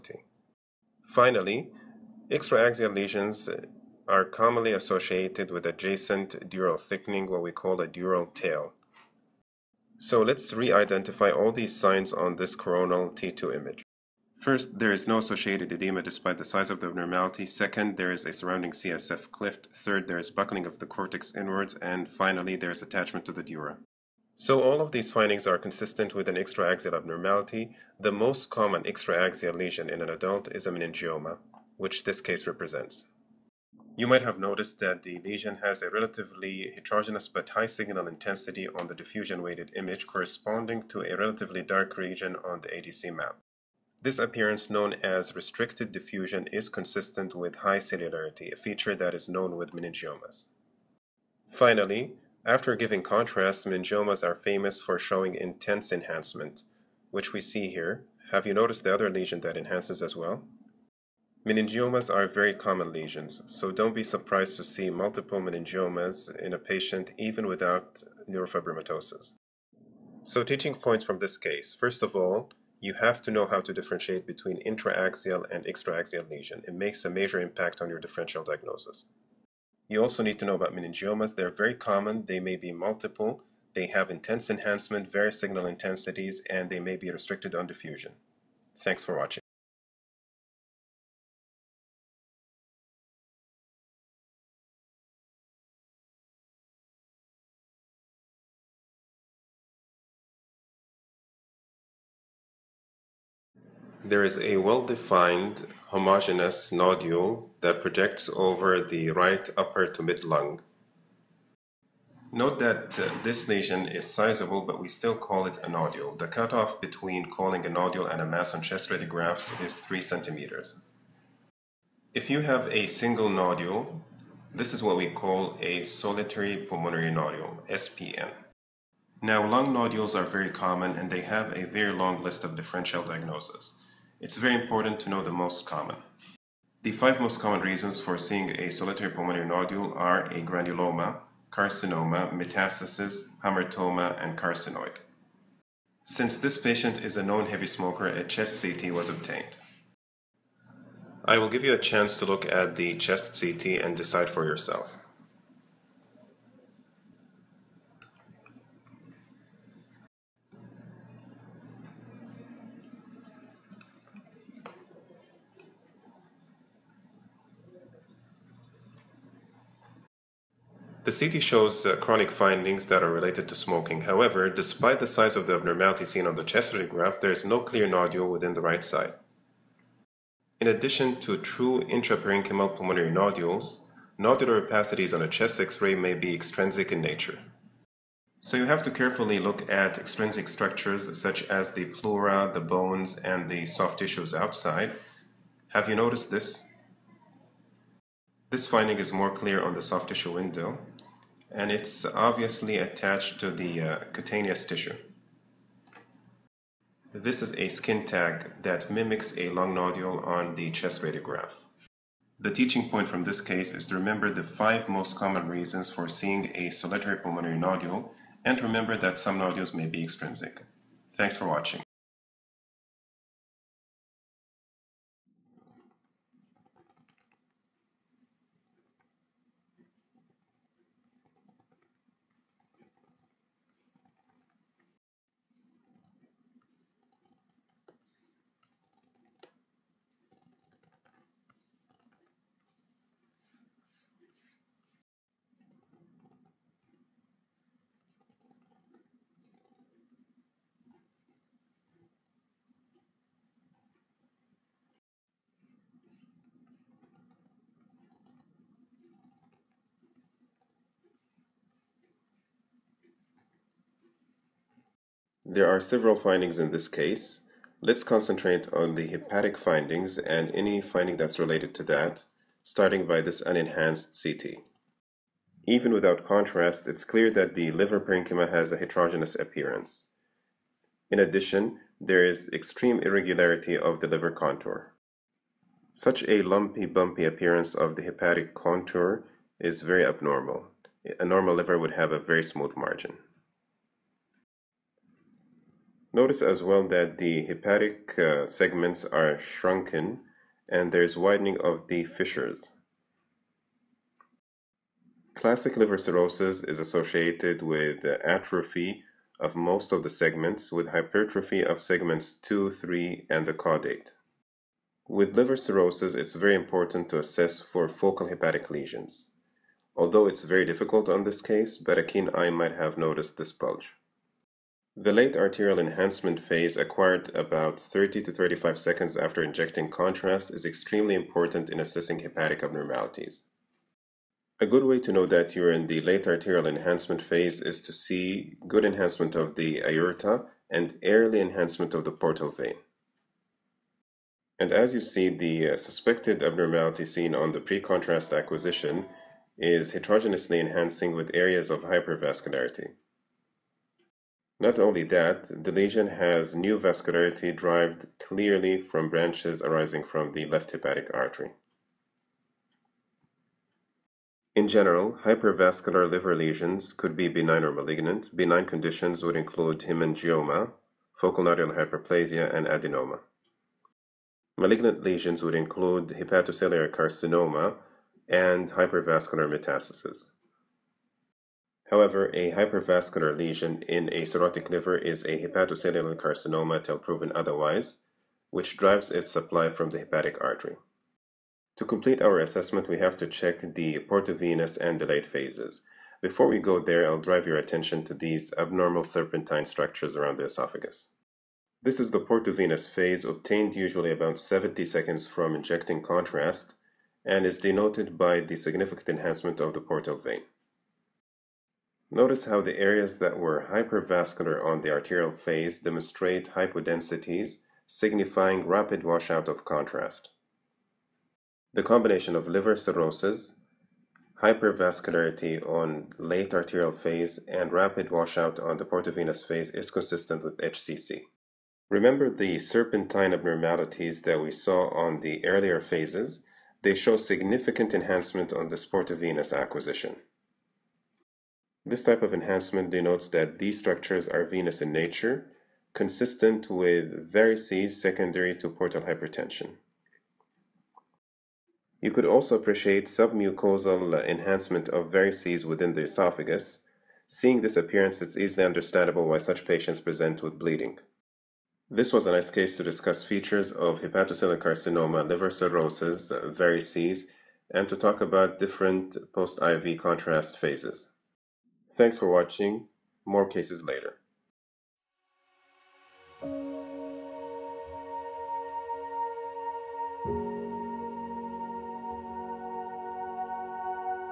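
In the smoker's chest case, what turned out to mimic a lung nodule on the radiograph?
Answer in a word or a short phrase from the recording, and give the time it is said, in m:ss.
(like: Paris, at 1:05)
skin tag, at 3:27.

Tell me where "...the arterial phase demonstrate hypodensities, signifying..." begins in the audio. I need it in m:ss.
6:54.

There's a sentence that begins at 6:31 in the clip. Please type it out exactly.
To complete our assessment, we have to check the portovenous and delayed phases.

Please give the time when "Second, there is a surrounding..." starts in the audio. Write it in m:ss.
0:17.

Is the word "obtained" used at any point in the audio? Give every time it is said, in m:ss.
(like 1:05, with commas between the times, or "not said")
2:29, 6:43.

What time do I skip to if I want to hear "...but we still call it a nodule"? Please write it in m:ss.
1:54.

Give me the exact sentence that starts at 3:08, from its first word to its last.
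So you have to carefully look at extrinsic structures such as the pleura, the bones, and the soft tissues outside.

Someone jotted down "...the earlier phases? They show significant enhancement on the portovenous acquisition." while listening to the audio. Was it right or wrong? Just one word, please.
right.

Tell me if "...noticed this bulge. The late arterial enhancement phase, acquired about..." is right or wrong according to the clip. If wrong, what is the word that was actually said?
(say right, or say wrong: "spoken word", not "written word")
right.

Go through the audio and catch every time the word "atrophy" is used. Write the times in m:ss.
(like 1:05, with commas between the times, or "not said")
5:08.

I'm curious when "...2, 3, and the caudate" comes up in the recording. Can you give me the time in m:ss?
5:12.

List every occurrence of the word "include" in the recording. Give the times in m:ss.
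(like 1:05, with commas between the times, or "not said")
6:09, 6:15.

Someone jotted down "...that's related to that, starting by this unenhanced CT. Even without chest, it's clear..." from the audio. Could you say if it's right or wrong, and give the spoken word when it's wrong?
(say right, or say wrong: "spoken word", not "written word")
wrong: "contrast", not "chest".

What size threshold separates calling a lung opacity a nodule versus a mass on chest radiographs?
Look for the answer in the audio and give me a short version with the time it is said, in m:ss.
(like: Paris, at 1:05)
3 centimeters, at 1:59.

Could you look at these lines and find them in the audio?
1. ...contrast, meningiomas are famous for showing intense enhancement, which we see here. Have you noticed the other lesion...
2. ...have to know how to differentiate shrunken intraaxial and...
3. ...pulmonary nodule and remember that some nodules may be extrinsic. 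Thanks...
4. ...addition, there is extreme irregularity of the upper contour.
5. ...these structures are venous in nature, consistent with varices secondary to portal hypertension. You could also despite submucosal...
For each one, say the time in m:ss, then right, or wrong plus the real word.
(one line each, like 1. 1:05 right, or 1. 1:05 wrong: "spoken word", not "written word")
1. 0:53 right
2. 1:12 wrong: "between", not "shrunken"
3. 3:37 right
4. 4:41 wrong: "liver", not "upper"
5. 7:23 wrong: "appreciate", not "despite".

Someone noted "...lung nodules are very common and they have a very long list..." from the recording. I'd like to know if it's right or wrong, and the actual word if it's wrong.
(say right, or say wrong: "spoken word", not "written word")
right.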